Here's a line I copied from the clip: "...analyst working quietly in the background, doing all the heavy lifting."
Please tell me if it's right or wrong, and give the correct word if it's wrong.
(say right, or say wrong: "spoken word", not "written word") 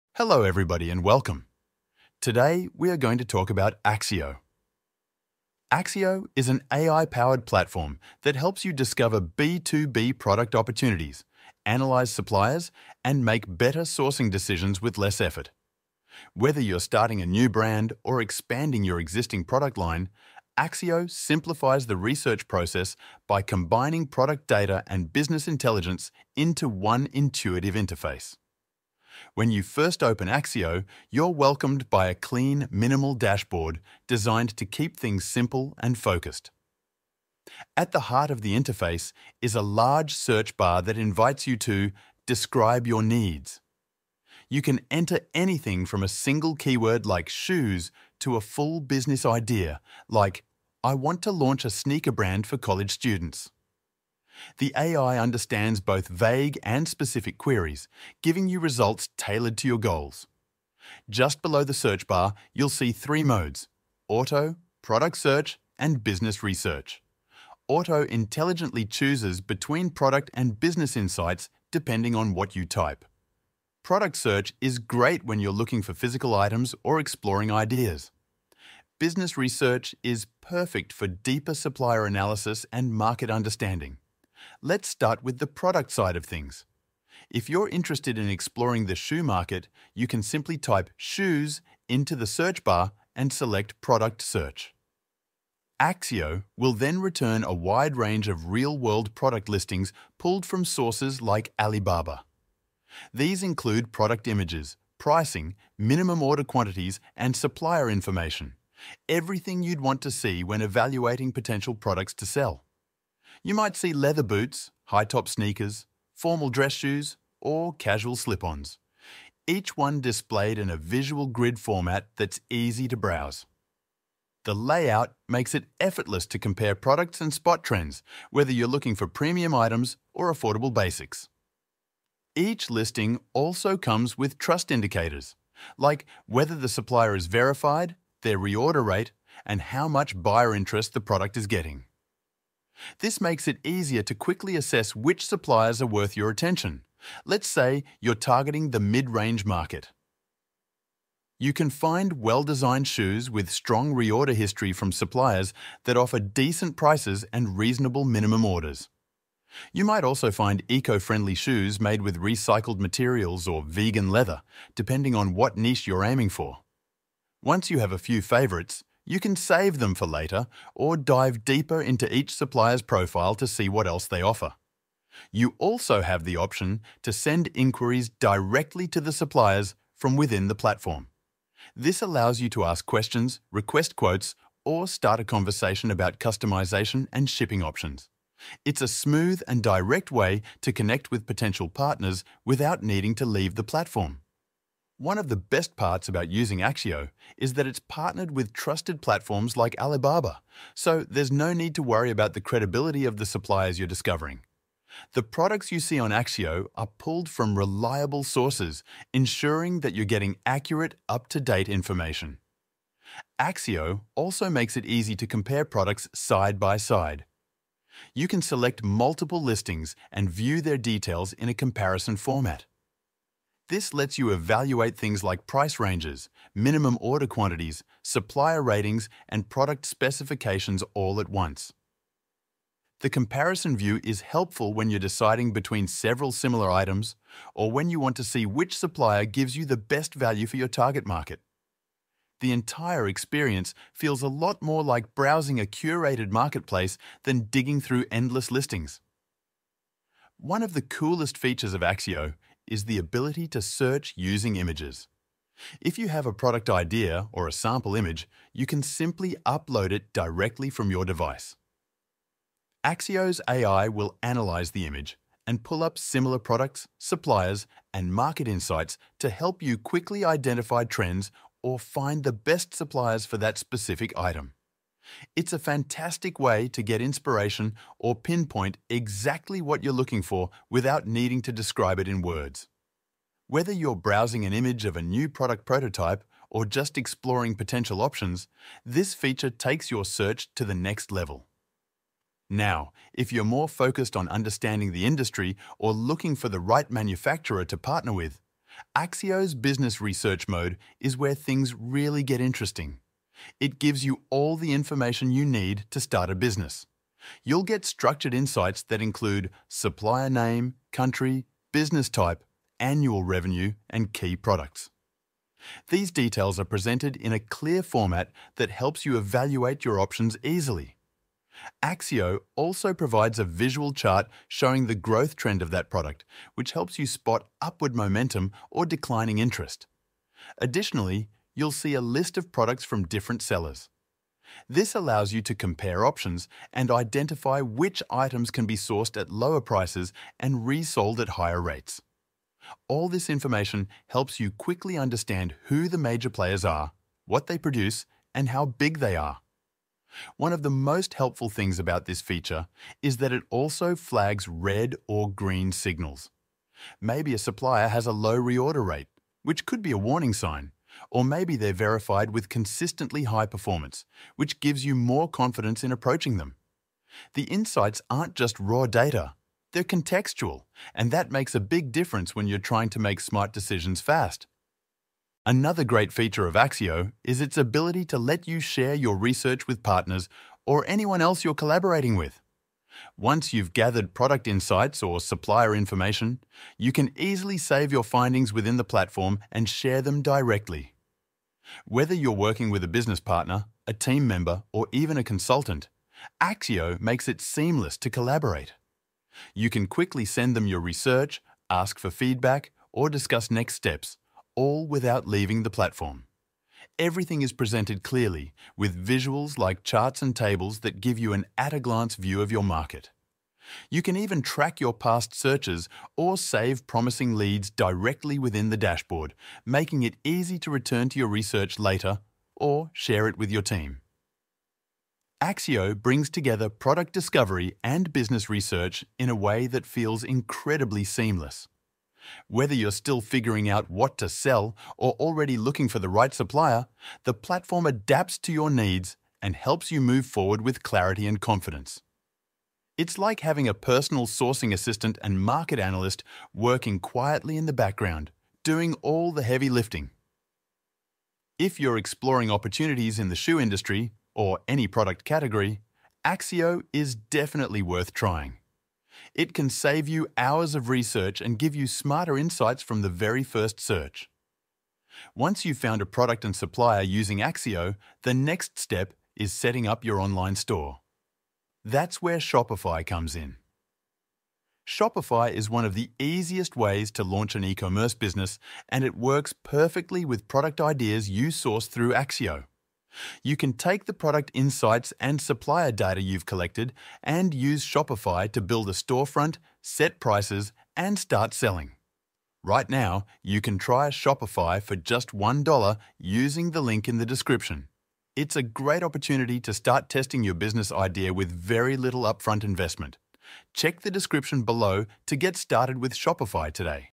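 right.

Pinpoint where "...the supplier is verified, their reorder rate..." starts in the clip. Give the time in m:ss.
2:16.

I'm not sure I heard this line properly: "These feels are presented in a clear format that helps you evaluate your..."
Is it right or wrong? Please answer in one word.
wrong.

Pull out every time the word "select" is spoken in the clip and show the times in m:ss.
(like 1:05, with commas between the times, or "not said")
1:33, 3:38.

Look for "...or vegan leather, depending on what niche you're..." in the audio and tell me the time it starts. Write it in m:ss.
2:43.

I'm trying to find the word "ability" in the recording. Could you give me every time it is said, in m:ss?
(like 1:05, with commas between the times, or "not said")
4:12, 6:17.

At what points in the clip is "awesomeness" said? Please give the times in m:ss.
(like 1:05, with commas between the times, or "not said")
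not said.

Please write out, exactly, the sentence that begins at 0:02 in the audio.
Today we are going to talk about Accio.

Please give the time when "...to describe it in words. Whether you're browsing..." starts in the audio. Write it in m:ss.
4:41.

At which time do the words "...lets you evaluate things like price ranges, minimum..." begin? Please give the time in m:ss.
3:43.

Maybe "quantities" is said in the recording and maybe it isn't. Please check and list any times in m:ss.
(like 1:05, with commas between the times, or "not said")
1:46, 3:47.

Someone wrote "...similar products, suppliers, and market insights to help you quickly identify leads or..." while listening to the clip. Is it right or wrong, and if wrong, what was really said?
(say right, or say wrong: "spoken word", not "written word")
wrong: "trends", not "leads".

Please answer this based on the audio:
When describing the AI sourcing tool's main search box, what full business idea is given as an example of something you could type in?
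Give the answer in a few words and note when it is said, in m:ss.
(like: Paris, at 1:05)
Launch a sneaker brand for college students, at 0:50.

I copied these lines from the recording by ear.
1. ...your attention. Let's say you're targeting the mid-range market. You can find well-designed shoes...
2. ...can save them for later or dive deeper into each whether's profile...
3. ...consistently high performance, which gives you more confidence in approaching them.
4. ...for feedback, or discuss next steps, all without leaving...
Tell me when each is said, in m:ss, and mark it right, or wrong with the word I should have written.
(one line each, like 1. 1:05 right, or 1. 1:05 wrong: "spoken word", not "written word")
1. 2:26 right
2. 2:49 wrong: "supplier", not "whether"
3. 6:02 right
4. 6:41 right.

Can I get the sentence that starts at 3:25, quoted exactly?
The products you see on Accio are pulled from reliable sources, ensuring that you're getting accurate, up-to-date information.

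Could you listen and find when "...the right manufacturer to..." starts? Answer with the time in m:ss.
4:56.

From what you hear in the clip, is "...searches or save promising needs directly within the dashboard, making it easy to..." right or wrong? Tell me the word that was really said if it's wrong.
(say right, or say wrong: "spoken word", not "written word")
wrong: "leads", not "needs".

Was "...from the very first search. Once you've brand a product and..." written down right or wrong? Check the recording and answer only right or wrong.
wrong.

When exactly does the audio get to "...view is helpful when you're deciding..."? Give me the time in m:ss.
3:53.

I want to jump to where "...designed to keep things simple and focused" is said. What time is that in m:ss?
0:34.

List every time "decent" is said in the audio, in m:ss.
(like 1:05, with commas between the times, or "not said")
2:36.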